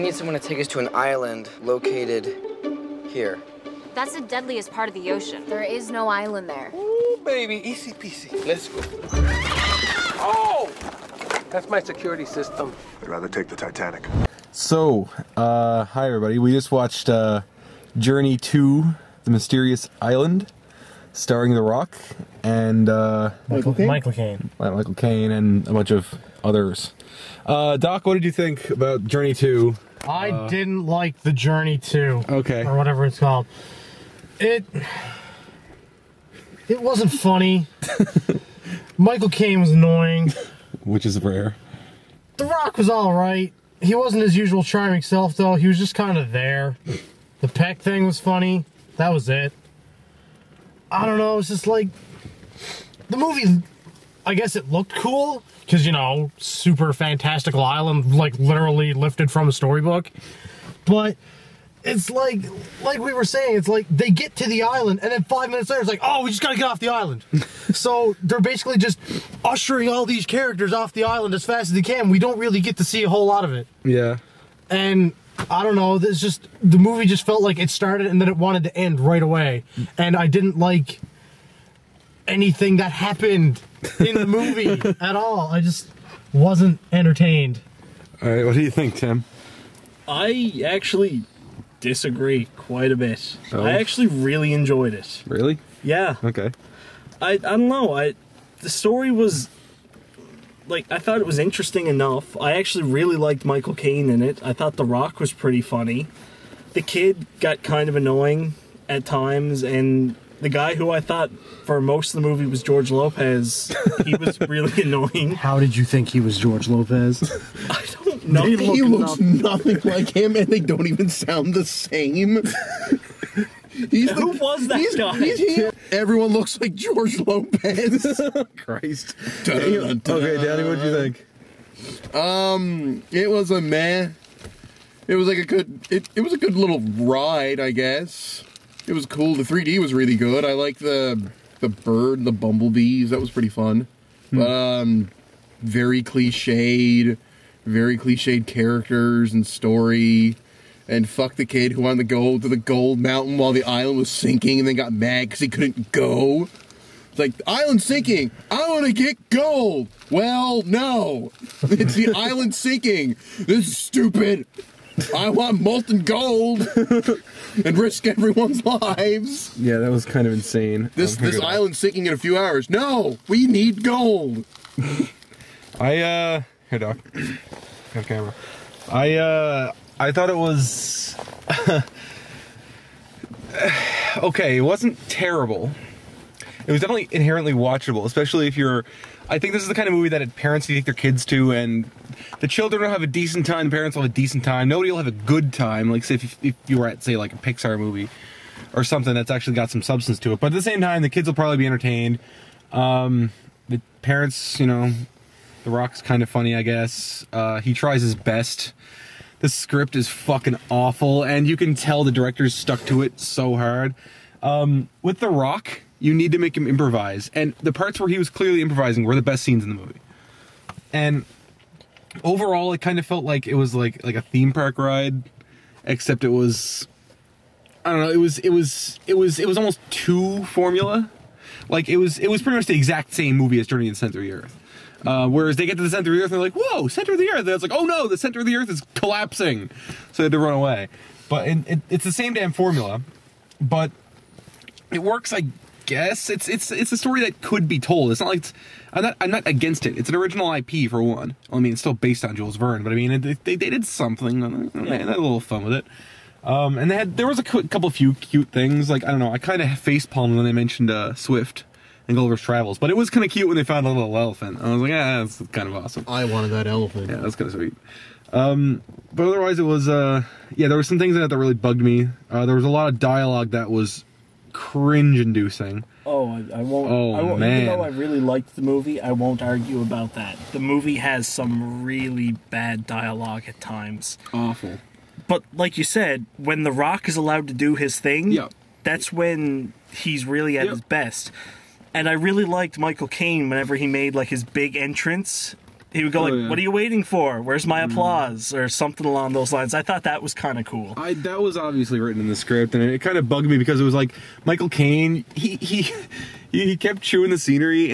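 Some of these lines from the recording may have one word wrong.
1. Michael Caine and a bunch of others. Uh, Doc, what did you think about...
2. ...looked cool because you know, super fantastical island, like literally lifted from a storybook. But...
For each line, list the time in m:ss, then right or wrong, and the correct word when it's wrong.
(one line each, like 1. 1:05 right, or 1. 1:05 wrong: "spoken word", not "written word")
1. 0:24 right
2. 0:54 right.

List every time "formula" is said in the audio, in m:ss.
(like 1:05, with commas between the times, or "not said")
3:50, 4:02.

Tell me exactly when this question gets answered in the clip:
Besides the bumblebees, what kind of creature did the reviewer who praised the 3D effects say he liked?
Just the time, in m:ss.
2:21.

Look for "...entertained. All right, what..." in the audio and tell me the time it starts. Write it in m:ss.
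1:26.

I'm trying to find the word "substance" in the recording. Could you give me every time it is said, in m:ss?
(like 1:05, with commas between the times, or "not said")
3:19.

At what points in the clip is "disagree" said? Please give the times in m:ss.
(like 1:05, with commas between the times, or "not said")
1:31.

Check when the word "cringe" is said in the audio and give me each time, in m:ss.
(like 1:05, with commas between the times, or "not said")
4:34.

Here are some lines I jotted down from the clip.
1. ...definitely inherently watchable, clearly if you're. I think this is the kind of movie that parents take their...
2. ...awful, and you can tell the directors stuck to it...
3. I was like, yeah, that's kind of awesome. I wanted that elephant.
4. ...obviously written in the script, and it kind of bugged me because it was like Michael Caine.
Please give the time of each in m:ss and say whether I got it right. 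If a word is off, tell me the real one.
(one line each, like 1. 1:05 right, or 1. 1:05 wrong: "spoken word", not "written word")
1. 3:06 wrong: "especially", not "clearly"
2. 3:30 right
3. 4:24 right
4. 5:01 right.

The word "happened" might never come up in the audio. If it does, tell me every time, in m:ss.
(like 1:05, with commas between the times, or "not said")
1:22.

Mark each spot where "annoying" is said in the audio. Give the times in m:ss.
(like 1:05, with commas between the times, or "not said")
0:39, 1:47, 1:54.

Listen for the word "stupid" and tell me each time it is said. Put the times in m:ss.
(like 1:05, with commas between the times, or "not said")
2:43.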